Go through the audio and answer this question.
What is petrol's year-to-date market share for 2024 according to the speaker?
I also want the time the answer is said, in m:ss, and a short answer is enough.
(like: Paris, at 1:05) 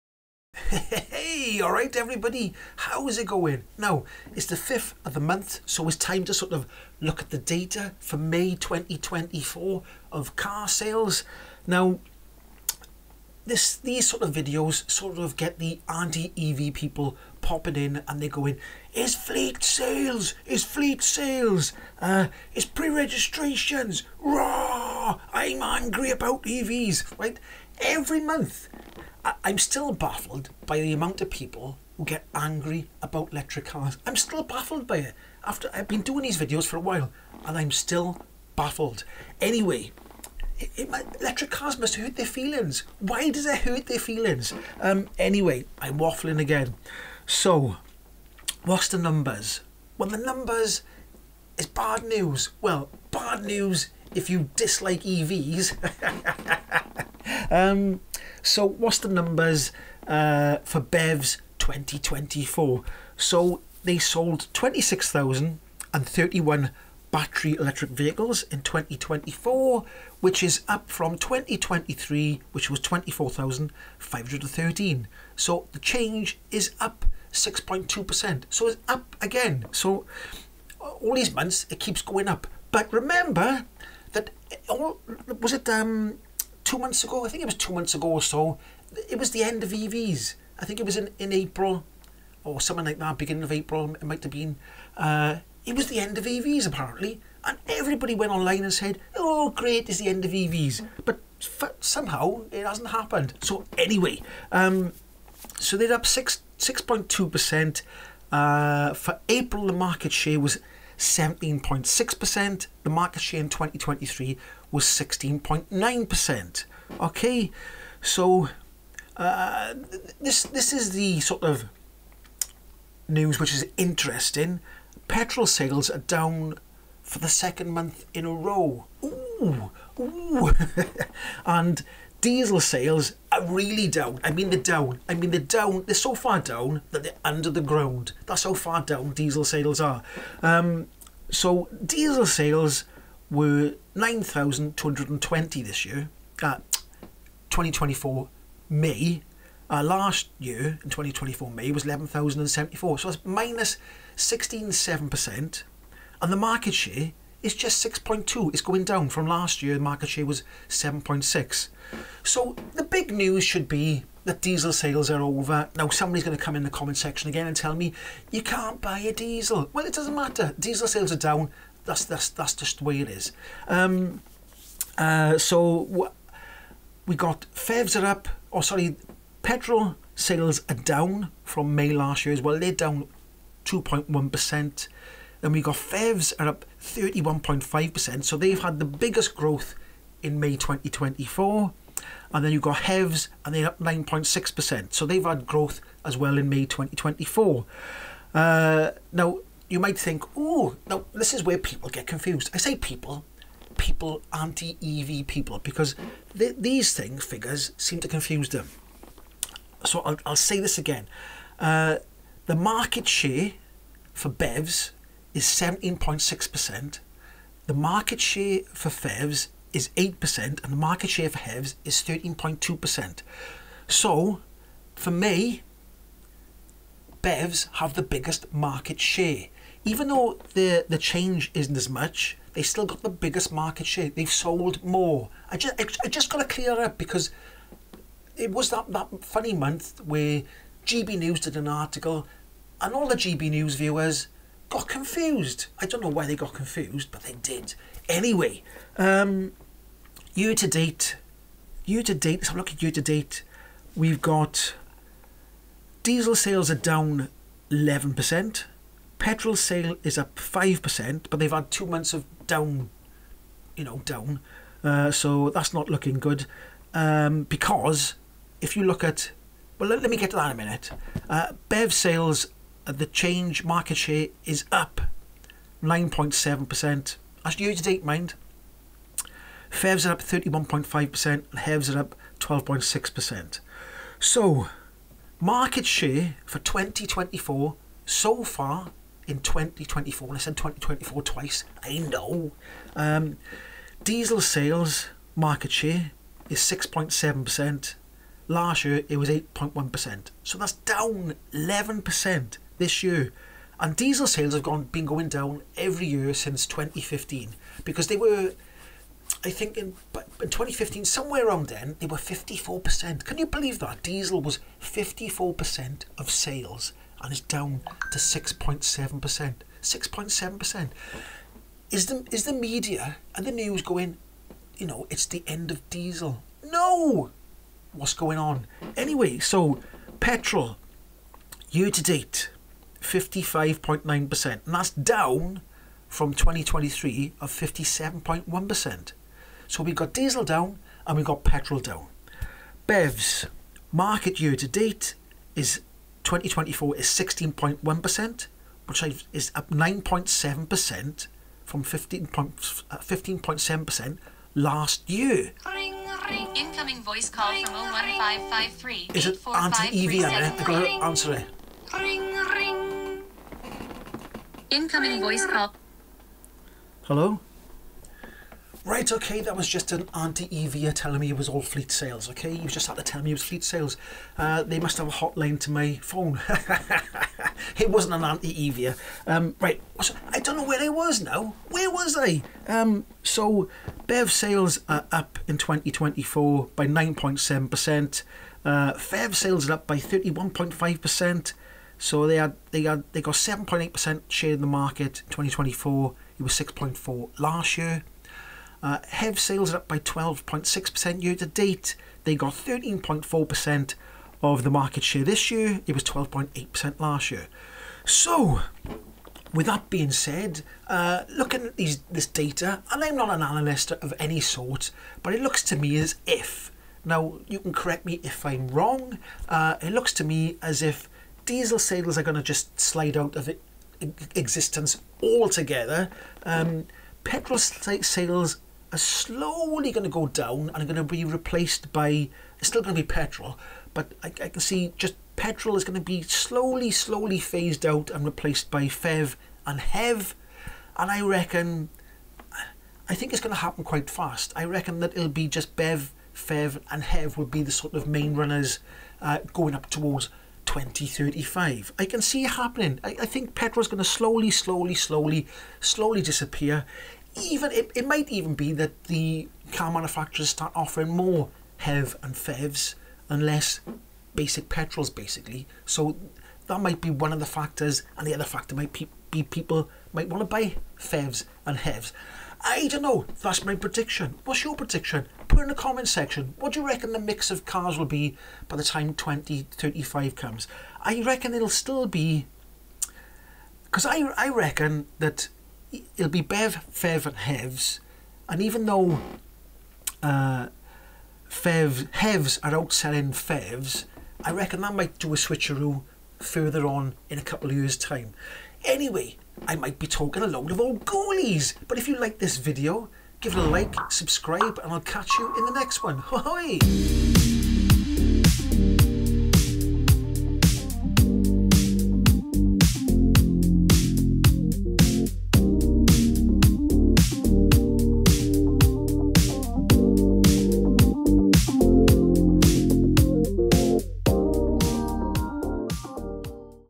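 55.9%, at 5:33.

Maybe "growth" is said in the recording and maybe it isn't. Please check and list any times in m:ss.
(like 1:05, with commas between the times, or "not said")
3:09, 3:15.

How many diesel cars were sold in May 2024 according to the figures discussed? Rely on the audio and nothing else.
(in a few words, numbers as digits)
9,220.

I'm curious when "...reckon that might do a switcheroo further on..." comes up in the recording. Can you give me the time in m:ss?
8:14.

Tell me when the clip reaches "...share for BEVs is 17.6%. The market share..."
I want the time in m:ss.
3:33.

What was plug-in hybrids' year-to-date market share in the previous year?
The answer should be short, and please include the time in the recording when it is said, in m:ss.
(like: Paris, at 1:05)
6.4%, at 6:36.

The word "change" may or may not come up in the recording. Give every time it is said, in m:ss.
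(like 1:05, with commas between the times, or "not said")
1:15, 3:50, 4:33.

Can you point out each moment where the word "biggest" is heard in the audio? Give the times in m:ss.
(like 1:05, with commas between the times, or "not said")
3:08, 3:48, 3:53.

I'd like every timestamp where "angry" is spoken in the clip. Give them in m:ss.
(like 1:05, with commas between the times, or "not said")
0:25, 0:32.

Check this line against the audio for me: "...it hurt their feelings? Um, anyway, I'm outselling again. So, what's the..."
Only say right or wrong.
wrong.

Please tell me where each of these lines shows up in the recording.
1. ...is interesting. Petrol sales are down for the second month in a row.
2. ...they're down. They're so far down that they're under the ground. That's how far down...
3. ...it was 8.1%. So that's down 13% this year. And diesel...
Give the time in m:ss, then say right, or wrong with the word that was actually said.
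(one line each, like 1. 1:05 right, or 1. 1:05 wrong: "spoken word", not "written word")
1. 2:03 right
2. 2:15 right
3. 4:59 wrong: "11", not "13".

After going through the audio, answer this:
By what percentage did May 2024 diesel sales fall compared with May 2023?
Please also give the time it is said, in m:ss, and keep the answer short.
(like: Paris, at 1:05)
16.7%, at 2:33.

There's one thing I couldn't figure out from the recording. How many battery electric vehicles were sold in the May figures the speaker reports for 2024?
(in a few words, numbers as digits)
26,031.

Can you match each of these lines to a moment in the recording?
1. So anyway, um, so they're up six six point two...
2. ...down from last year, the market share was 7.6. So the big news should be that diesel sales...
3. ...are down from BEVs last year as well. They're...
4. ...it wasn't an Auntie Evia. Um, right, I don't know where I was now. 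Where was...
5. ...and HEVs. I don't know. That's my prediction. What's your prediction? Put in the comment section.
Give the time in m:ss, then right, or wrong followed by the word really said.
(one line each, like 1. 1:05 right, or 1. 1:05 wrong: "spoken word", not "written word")
1. 1:43 right
2. 2:38 right
3. 3:00 wrong: "May", not "BEVs"
4. 6:17 right
5. 7:51 right.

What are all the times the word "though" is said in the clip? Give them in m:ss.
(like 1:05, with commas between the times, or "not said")
3:50, 8:08.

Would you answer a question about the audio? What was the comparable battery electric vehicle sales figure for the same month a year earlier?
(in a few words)
24,513.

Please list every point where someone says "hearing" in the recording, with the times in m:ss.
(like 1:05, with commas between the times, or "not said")
not said.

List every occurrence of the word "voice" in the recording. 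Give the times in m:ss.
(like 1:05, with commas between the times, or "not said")
5:57, 6:05.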